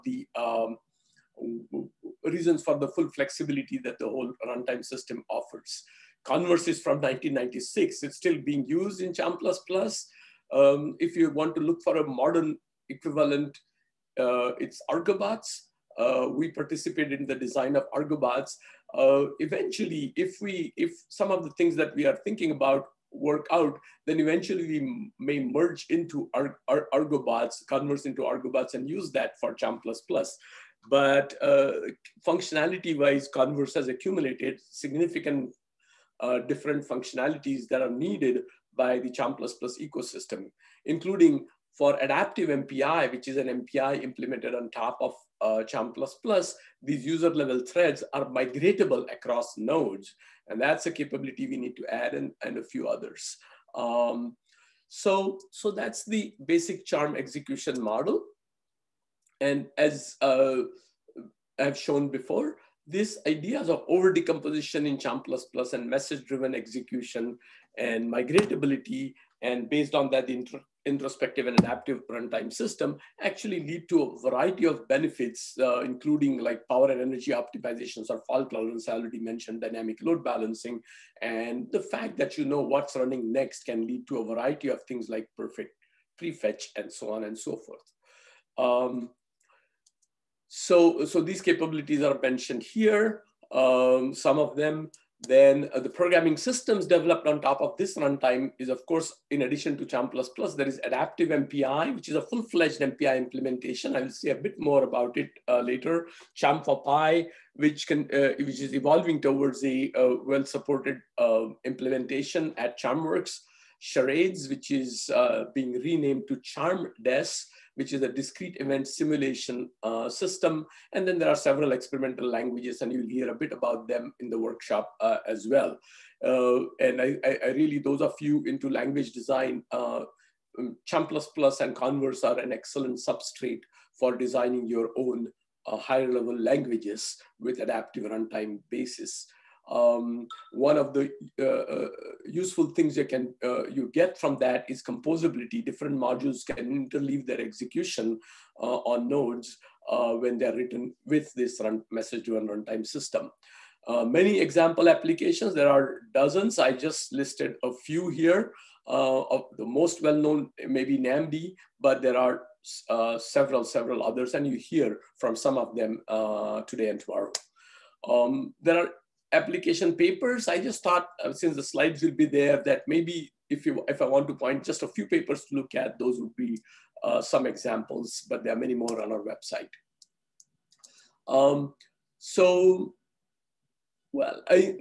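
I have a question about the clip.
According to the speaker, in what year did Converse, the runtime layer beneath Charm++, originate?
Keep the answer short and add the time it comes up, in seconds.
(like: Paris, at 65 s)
1996, at 6 s.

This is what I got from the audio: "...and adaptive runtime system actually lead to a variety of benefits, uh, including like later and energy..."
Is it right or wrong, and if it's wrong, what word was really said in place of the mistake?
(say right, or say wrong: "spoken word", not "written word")
wrong: "power", not "later".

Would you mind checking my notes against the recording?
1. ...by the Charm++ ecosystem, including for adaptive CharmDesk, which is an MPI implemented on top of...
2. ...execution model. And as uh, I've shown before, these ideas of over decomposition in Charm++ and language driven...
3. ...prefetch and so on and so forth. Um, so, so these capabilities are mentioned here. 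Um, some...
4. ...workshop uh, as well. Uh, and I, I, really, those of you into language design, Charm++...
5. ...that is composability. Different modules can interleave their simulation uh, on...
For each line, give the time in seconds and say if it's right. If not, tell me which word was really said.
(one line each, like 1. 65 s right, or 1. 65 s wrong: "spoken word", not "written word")
1. 38 s wrong: "MPI", not "CharmDesk"
2. 57 s wrong: "message", not "language"
3. 86 s right
4. 124 s right
5. 144 s wrong: "execution", not "simulation".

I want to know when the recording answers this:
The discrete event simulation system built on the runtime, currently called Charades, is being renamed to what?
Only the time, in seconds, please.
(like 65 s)
116 s.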